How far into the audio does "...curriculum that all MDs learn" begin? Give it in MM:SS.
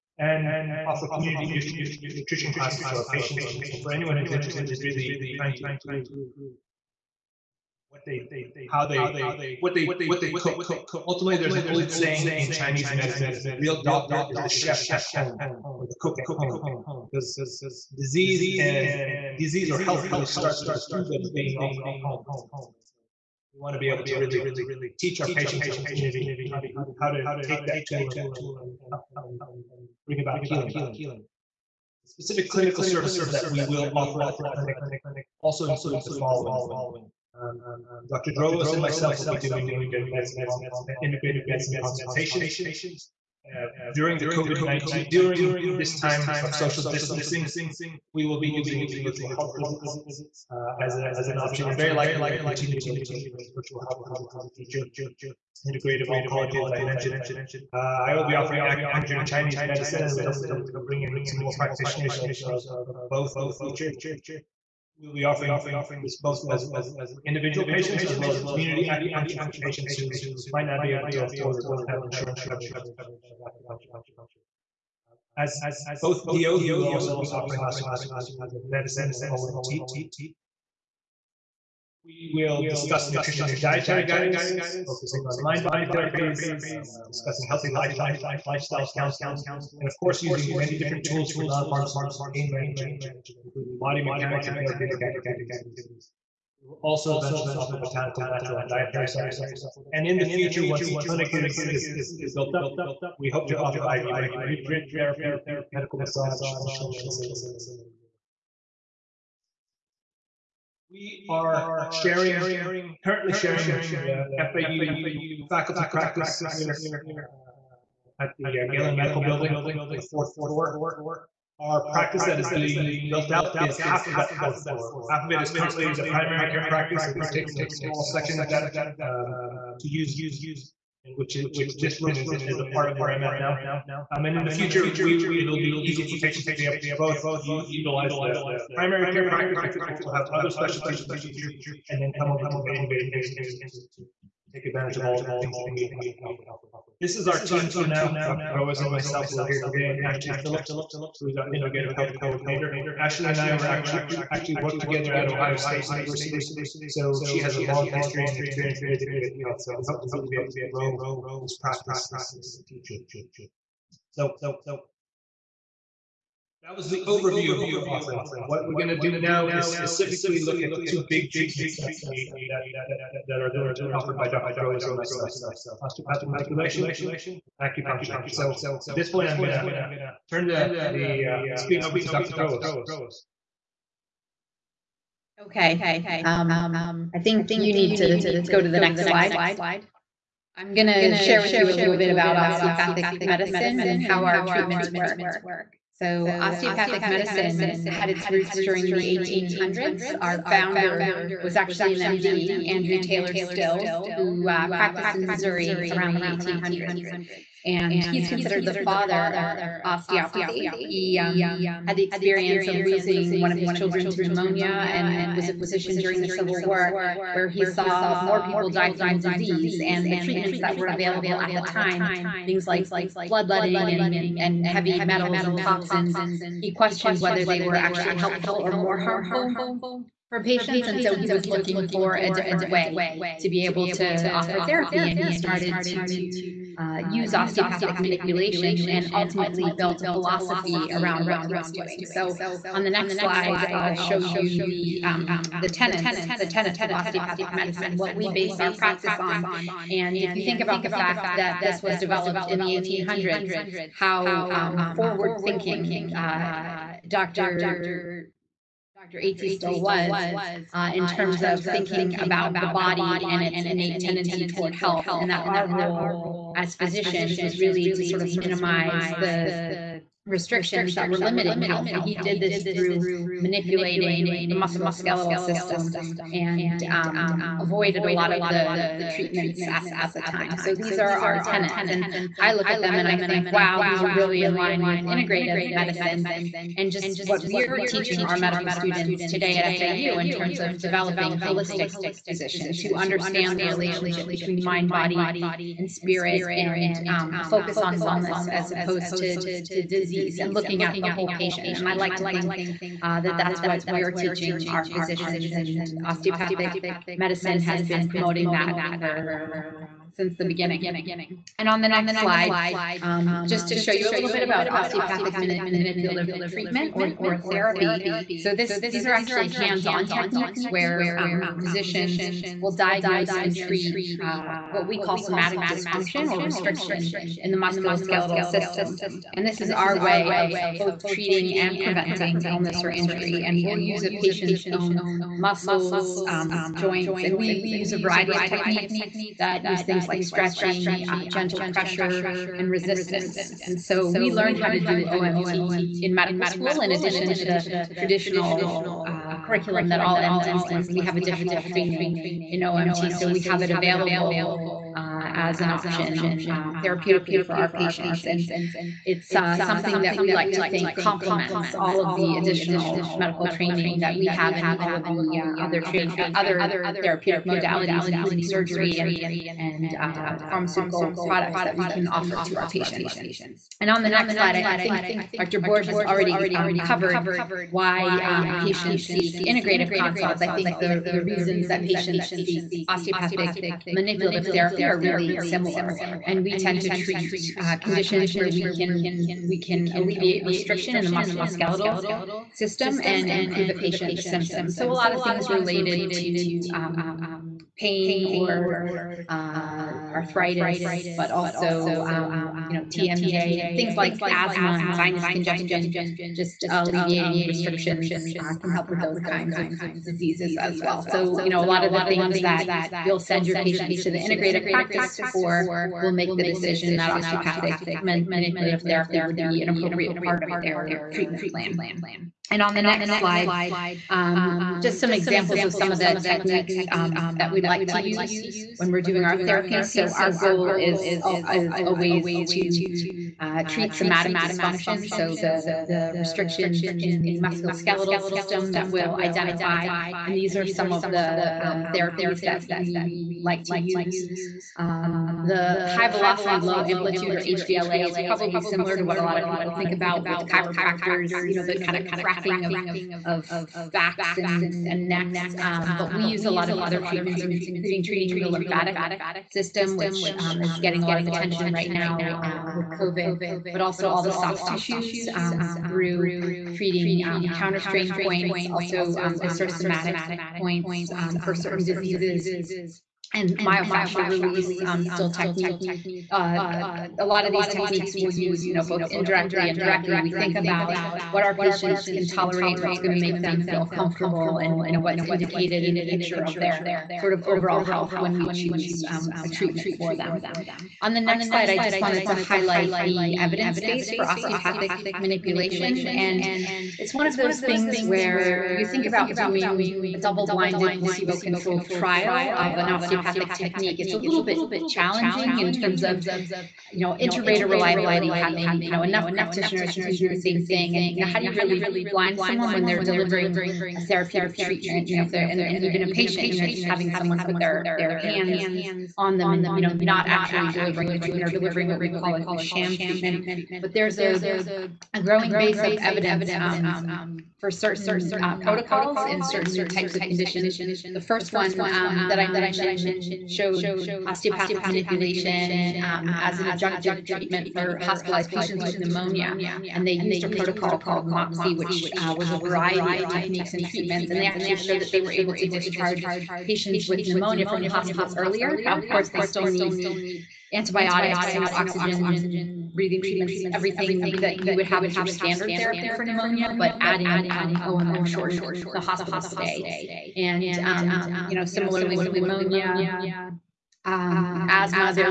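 05:49.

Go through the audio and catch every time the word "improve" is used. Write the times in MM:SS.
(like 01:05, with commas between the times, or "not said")
00:05, 06:33.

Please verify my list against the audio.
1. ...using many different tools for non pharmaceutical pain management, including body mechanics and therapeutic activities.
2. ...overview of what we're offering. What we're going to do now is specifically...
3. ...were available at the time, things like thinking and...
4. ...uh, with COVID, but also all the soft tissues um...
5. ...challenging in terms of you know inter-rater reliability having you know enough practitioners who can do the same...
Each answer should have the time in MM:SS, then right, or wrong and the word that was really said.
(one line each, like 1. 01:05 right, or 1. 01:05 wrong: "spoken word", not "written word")
1. 01:30 right
2. 02:47 right
3. 03:40 wrong: "bloodletting", not "thinking"
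4. 07:42 right
5. 08:24 right.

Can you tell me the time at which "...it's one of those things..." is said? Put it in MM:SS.
08:16.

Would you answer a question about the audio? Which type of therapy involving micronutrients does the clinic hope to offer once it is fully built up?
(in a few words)
IV micronutrient therapy.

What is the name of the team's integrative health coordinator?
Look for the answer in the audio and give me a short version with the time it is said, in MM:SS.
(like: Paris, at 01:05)
Ashley Phillips, at 02:30.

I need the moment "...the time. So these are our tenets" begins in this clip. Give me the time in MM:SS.
04:40.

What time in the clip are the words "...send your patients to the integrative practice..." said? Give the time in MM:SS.
06:53.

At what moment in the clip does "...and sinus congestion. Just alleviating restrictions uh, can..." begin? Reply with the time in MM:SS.
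06:44.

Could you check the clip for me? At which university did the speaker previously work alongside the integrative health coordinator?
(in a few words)
Ohio State University.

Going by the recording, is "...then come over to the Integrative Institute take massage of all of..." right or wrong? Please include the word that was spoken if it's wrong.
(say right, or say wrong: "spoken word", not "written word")
wrong: "advantage", not "massage".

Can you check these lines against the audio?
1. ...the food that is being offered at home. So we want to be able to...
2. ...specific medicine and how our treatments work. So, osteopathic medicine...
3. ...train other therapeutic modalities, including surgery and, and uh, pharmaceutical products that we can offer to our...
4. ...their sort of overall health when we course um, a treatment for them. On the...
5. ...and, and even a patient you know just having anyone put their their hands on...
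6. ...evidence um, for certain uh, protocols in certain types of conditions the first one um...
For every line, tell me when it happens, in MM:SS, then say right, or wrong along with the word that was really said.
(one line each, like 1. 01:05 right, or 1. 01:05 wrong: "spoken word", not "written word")
1. 00:20 right
2. 03:12 wrong: "osteopathic", not "specific"
3. 06:05 right
4. 08:06 wrong: "choose", not "course"
5. 08:35 wrong: "someone", not "anyone"
6. 08:45 right.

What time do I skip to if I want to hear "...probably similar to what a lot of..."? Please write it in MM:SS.
07:28.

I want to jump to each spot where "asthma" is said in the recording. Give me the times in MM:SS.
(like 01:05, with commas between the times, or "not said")
06:44, 09:24.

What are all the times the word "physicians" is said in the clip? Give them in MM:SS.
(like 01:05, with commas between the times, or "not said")
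03:35, 04:26, 04:52, 05:04, 05:21.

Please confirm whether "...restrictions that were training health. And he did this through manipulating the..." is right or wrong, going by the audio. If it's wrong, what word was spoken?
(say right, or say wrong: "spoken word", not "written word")
wrong: "limiting", not "training".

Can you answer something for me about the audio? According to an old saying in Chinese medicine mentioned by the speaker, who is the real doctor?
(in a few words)
The cook at home.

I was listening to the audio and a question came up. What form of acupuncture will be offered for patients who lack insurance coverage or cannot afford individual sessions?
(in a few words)
Community acupuncture.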